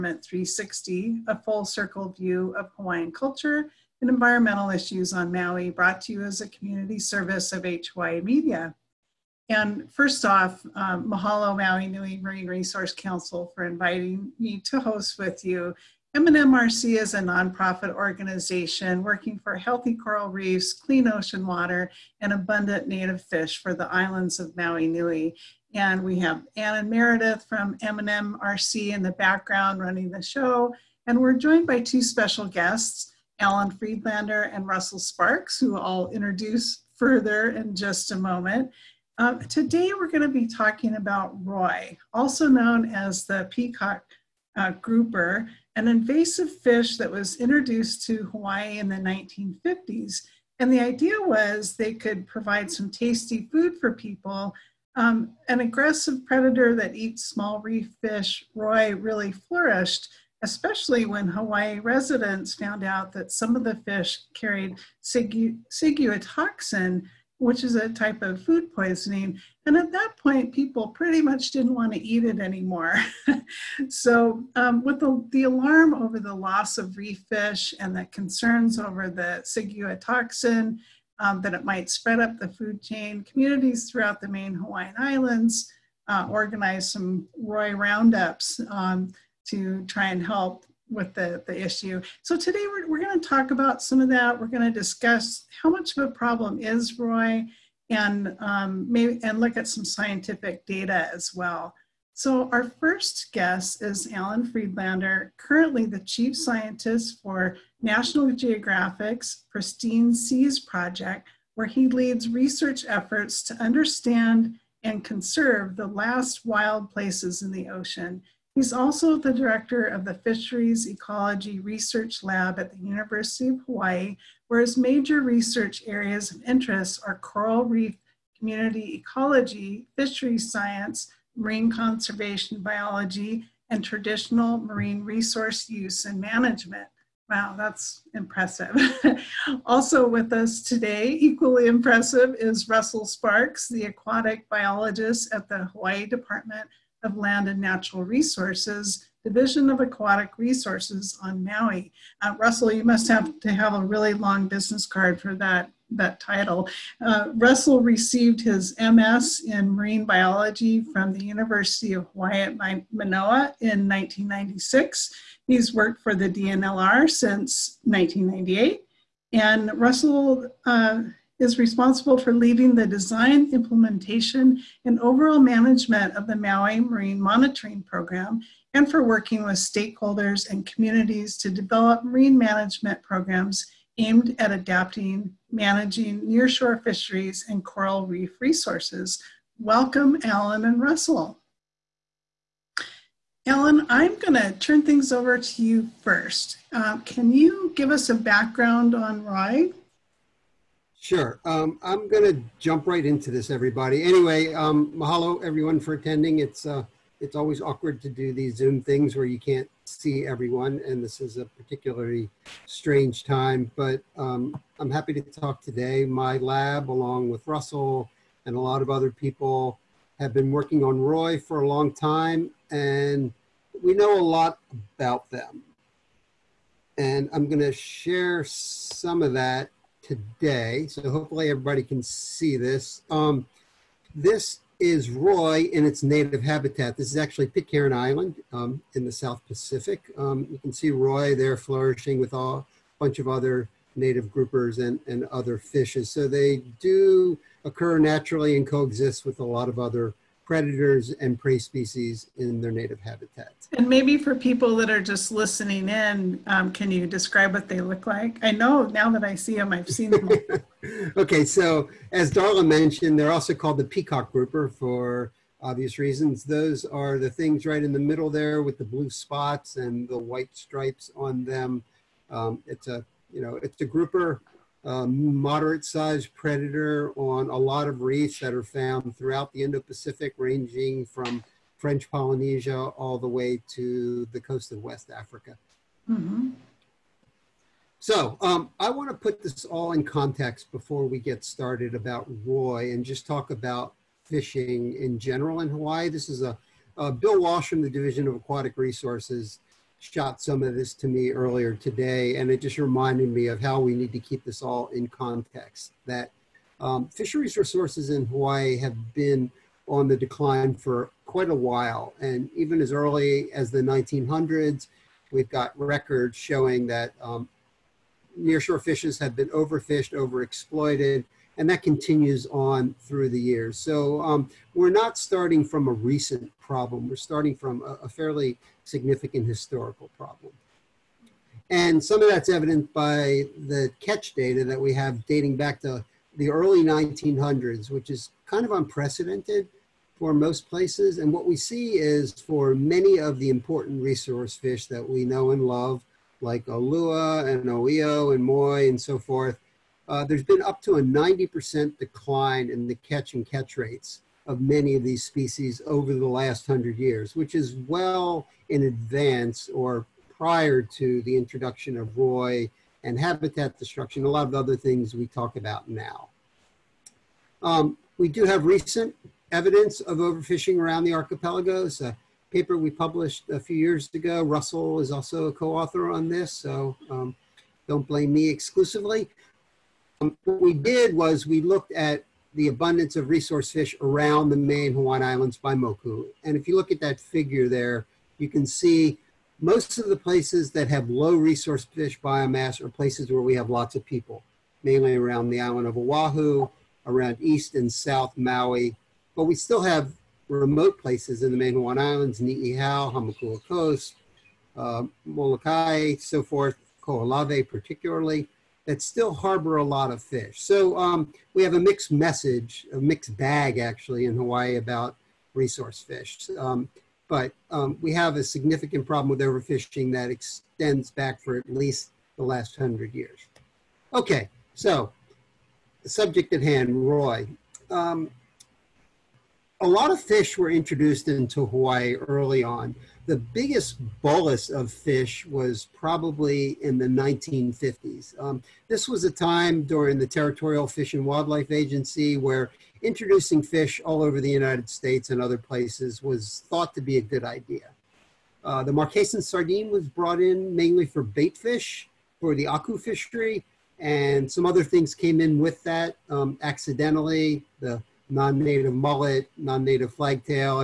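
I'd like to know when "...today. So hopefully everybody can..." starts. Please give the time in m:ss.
3:50.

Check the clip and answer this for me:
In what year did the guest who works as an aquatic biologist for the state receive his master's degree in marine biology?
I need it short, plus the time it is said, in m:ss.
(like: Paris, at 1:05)
1996, at 2:43.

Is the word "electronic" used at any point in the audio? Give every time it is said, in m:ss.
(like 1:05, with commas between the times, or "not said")
not said.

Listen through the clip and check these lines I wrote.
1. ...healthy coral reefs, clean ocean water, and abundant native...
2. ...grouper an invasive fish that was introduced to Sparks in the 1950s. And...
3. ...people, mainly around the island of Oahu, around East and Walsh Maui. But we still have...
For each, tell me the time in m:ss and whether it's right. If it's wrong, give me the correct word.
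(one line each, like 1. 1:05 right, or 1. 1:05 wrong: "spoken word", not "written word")
1. 0:19 right
2. 0:44 wrong: "Hawaii", not "Sparks"
3. 6:34 wrong: "South", not "Walsh".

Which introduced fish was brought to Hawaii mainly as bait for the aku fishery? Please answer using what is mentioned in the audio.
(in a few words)
Marquesan sardine.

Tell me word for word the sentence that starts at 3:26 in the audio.
It's uh, it's always awkward to do these Zoom things where you can't see everyone, and this is a particularly strange time.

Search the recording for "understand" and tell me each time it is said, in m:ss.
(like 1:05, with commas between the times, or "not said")
1:53.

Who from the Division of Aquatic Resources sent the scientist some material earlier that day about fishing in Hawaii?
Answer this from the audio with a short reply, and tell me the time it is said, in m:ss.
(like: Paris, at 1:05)
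Bill Walsh, at 4:57.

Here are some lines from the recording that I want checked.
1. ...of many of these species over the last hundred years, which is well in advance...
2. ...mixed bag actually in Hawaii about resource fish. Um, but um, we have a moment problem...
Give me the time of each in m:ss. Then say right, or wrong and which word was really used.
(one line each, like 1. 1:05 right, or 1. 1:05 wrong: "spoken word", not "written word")
1. 5:54 right
2. 6:52 wrong: "significant", not "moment".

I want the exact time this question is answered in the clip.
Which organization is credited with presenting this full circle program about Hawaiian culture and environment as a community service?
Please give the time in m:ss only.
0:07.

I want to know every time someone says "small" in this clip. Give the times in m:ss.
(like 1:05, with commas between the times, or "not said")
0:57.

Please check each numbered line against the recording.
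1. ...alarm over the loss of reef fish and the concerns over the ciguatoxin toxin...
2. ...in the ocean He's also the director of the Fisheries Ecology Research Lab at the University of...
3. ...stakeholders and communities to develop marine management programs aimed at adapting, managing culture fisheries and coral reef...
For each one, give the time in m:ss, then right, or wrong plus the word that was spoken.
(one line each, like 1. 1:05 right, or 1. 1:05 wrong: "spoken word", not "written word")
1. 1:15 right
2. 1:57 right
3. 2:59 wrong: "nearshore", not "culture".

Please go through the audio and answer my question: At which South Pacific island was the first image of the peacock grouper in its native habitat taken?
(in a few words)
Pitcairn Island.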